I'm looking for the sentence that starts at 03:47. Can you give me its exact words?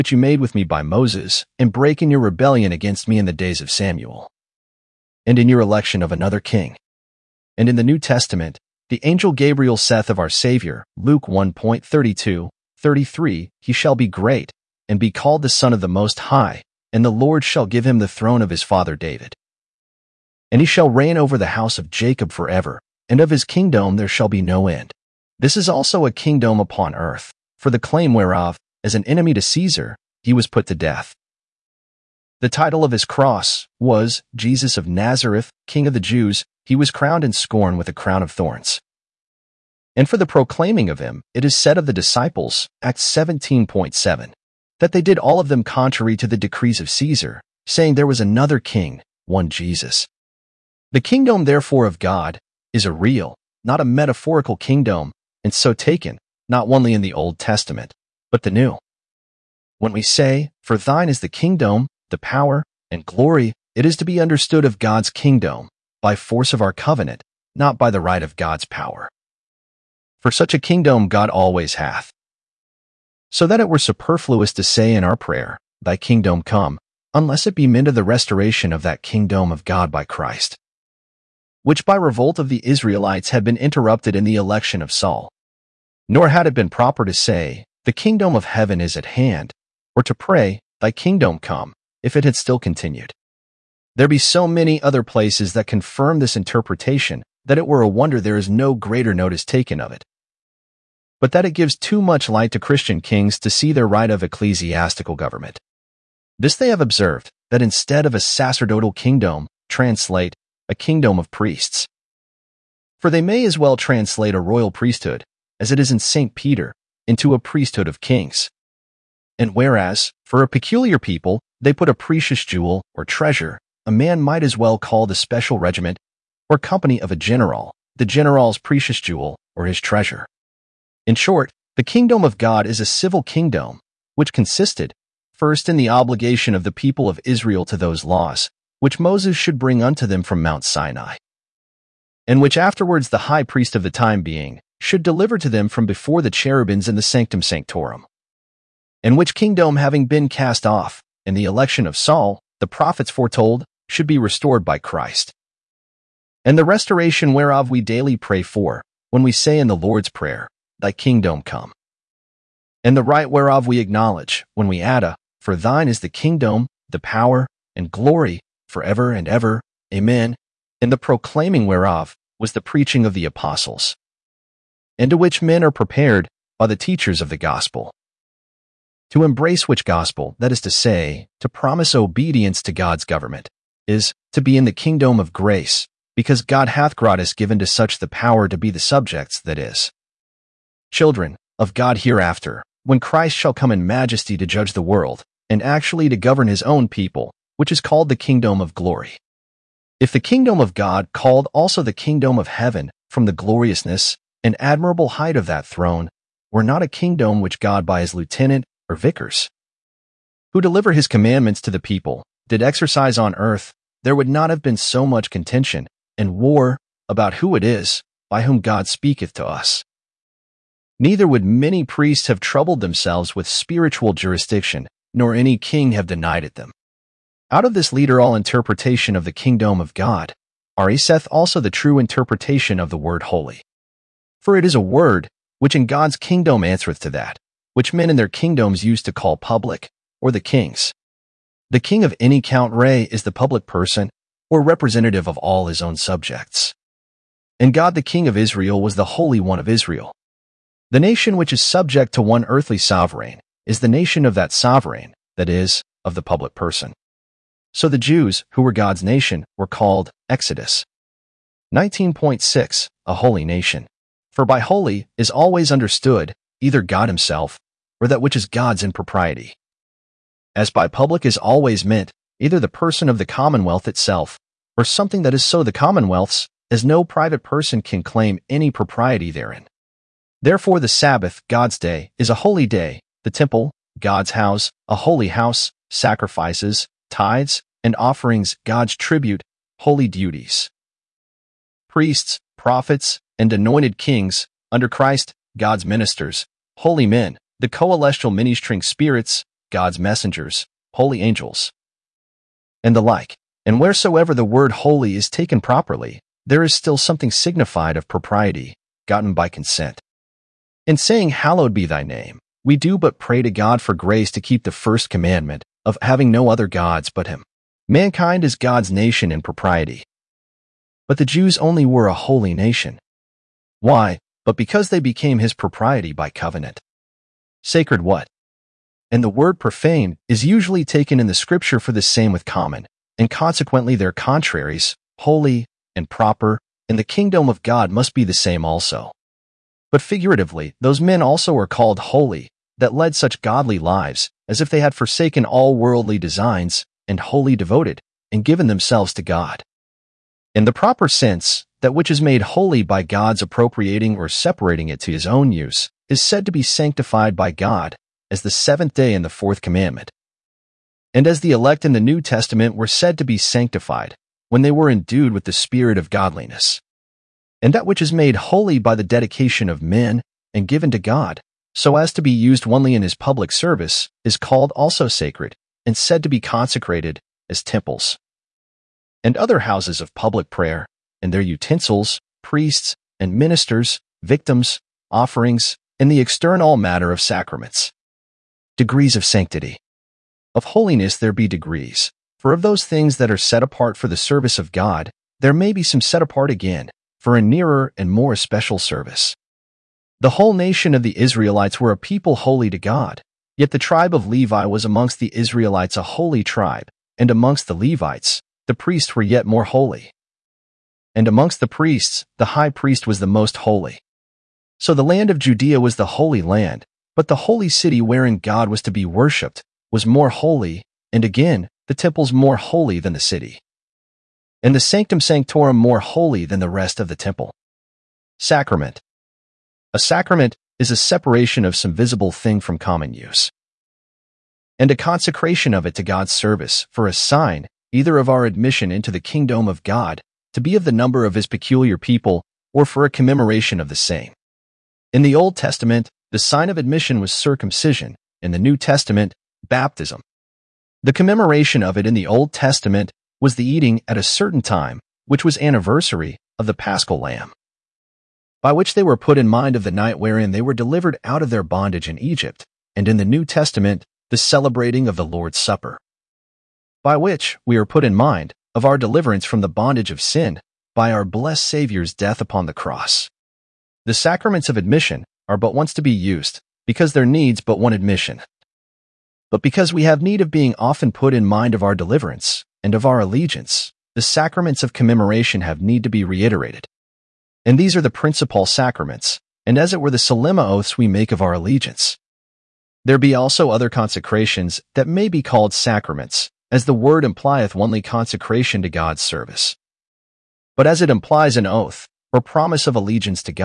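Out of this leader all interpretation of the kingdom of God, seth also the true interpretation of the word holy.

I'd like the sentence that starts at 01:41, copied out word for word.
But that it gives too much light to Christian kings to see their right of ecclesiastical government.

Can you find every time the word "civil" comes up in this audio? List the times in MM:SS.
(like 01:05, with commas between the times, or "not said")
02:12.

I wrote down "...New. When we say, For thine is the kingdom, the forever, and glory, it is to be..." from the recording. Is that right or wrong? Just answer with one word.
wrong.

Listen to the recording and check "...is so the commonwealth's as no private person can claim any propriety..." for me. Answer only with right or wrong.
right.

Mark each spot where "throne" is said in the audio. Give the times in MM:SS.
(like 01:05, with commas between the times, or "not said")
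00:18, 03:25.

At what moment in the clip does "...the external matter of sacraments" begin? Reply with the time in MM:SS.
06:26.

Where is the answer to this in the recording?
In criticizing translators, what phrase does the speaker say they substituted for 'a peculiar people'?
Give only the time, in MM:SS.
02:01.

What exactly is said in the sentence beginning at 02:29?
And which kingdom having been cast off, in the election of Saul, the prophets foretold, should be restored by Christ.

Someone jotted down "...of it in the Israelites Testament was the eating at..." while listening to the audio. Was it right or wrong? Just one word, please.
wrong.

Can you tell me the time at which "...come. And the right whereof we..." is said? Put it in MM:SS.
02:41.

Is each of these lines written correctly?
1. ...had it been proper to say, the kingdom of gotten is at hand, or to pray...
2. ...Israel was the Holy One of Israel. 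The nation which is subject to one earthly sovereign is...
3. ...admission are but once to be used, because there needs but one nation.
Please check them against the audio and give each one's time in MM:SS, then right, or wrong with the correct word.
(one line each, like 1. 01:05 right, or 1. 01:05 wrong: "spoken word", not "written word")
1. 01:26 wrong: "heaven", not "gotten"
2. 04:08 right
3. 07:54 wrong: "admission", not "nation".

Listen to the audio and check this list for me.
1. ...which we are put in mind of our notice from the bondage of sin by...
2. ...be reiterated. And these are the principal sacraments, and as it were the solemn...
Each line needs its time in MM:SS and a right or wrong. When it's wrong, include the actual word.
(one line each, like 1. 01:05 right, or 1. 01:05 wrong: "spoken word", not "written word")
1. 07:47 wrong: "deliverance", not "notice"
2. 08:06 right.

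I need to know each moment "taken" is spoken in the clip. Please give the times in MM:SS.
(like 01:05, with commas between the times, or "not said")
00:55, 01:39, 05:05, 05:30.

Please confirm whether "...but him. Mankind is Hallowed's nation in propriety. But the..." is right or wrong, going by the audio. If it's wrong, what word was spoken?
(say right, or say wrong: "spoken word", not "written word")
wrong: "God", not "Hallowed".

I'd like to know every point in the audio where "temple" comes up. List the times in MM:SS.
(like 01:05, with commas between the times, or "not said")
04:43, 06:17, 07:01, 07:07.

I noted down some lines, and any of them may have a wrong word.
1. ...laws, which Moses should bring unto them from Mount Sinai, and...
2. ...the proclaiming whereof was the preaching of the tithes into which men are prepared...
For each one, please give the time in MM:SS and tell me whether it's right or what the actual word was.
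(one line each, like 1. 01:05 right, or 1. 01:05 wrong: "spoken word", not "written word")
1. 02:18 right
2. 02:50 wrong: "apostles", not "tithes".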